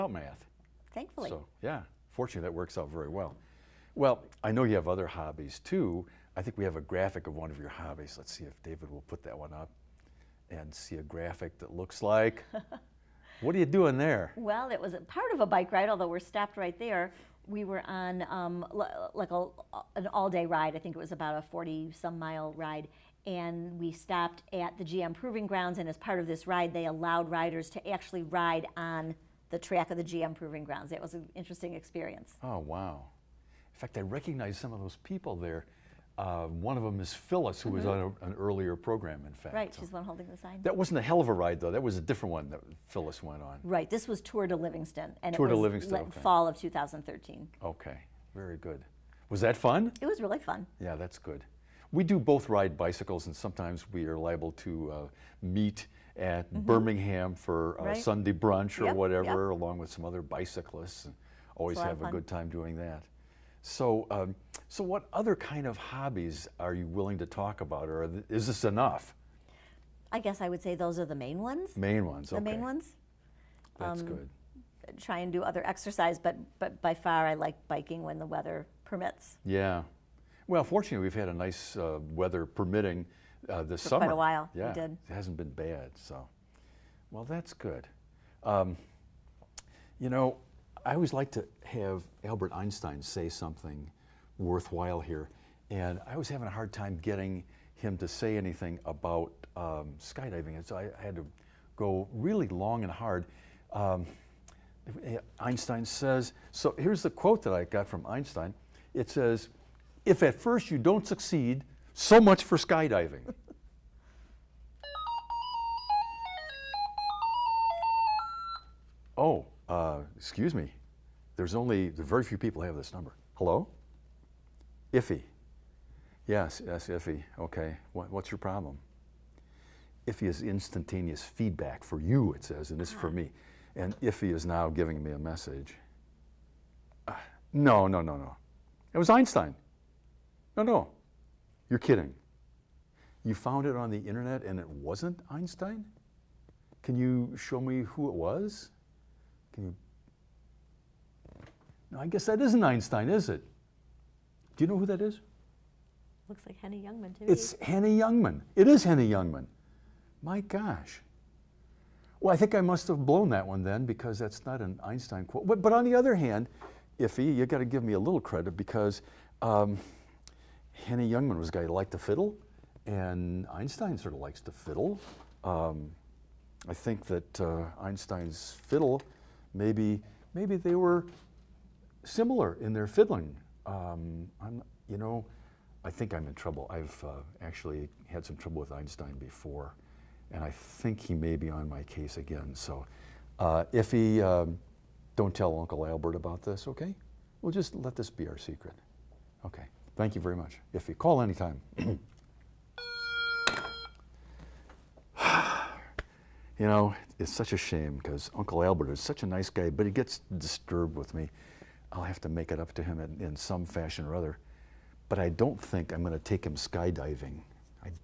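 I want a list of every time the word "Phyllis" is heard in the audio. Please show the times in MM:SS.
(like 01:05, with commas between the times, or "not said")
00:37, 00:42.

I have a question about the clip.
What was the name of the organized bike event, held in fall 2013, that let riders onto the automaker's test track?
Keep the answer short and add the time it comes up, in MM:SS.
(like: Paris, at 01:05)
Tour de Livingston, at 00:44.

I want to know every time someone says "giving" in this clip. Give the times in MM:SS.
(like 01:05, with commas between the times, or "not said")
02:14.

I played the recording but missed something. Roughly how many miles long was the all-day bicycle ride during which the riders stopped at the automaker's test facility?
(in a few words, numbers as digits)
40-some miles.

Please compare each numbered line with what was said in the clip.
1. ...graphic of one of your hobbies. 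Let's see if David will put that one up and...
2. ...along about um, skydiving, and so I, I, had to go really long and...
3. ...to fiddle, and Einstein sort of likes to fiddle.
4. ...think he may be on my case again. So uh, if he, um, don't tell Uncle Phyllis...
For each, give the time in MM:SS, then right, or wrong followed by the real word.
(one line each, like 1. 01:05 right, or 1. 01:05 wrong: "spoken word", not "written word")
1. 00:06 right
2. 01:38 wrong: "anything", not "along"
3. 02:51 right
4. 03:10 wrong: "Albert", not "Phyllis".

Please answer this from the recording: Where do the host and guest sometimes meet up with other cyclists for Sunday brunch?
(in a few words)
Birmingham.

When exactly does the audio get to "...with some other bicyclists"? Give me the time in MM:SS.
00:59.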